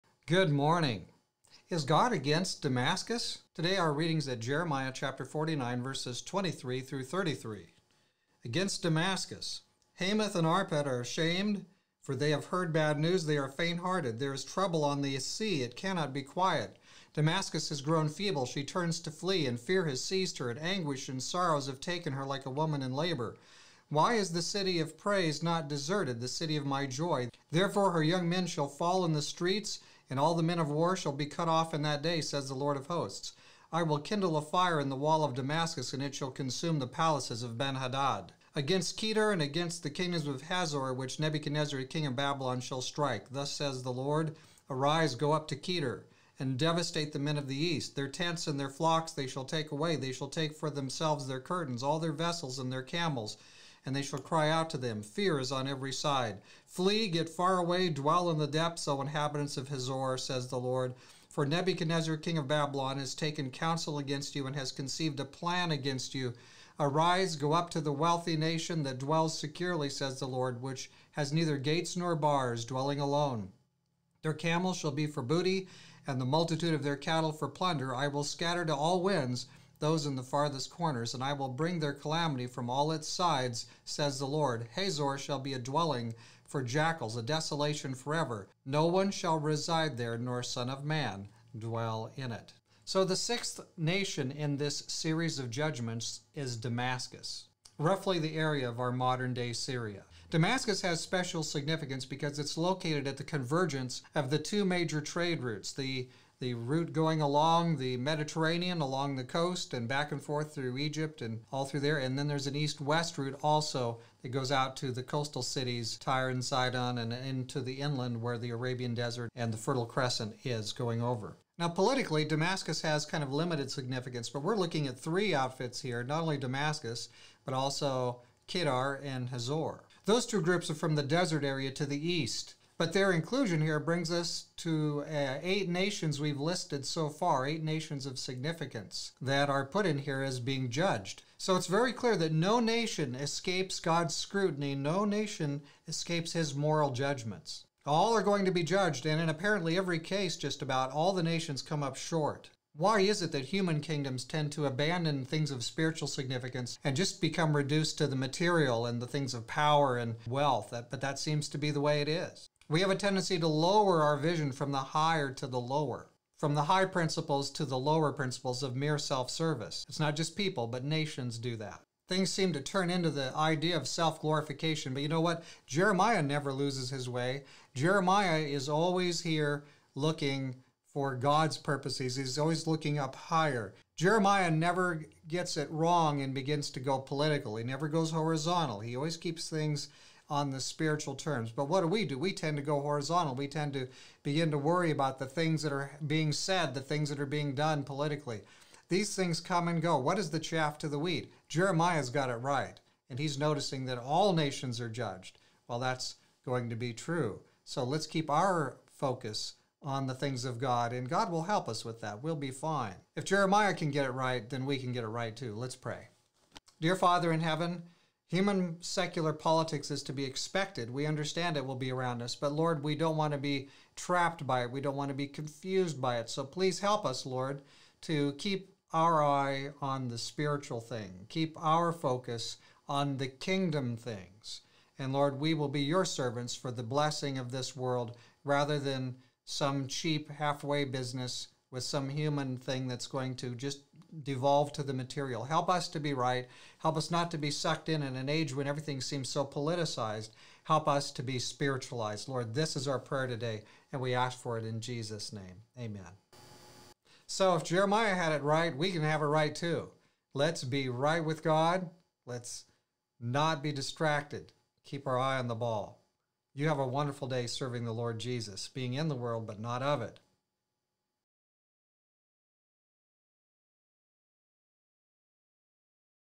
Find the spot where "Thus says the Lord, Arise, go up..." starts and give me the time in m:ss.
0:43.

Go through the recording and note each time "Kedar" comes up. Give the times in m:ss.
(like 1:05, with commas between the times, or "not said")
0:38, 0:45, 2:08.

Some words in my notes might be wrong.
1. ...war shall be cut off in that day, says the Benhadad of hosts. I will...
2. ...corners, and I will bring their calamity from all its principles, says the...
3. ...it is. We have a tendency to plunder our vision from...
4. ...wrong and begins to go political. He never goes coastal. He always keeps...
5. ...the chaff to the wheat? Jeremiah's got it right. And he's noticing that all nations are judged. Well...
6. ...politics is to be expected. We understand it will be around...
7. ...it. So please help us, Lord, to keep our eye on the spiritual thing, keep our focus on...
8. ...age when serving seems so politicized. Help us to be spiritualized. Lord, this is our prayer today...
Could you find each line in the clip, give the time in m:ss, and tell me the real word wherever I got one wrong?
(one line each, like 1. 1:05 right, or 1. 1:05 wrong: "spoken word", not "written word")
1. 0:30 wrong: "Lord", not "Benhadad"
2. 1:20 wrong: "sides", not "principles"
3. 2:42 wrong: "lower", not "plunder"
4. 3:05 wrong: "horizontal", not "coastal"
5. 3:20 right
6. 3:39 right
7. 3:46 right
8. 4:08 wrong: "everything", not "serving".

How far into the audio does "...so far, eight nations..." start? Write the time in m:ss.
2:16.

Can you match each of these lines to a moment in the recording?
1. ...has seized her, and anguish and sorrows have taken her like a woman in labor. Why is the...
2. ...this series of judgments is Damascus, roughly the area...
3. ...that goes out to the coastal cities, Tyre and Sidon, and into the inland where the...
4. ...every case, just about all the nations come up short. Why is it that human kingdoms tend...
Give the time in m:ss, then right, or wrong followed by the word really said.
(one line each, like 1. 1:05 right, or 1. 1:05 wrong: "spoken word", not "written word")
1. 0:19 right
2. 1:34 right
3. 1:54 right
4. 2:29 right.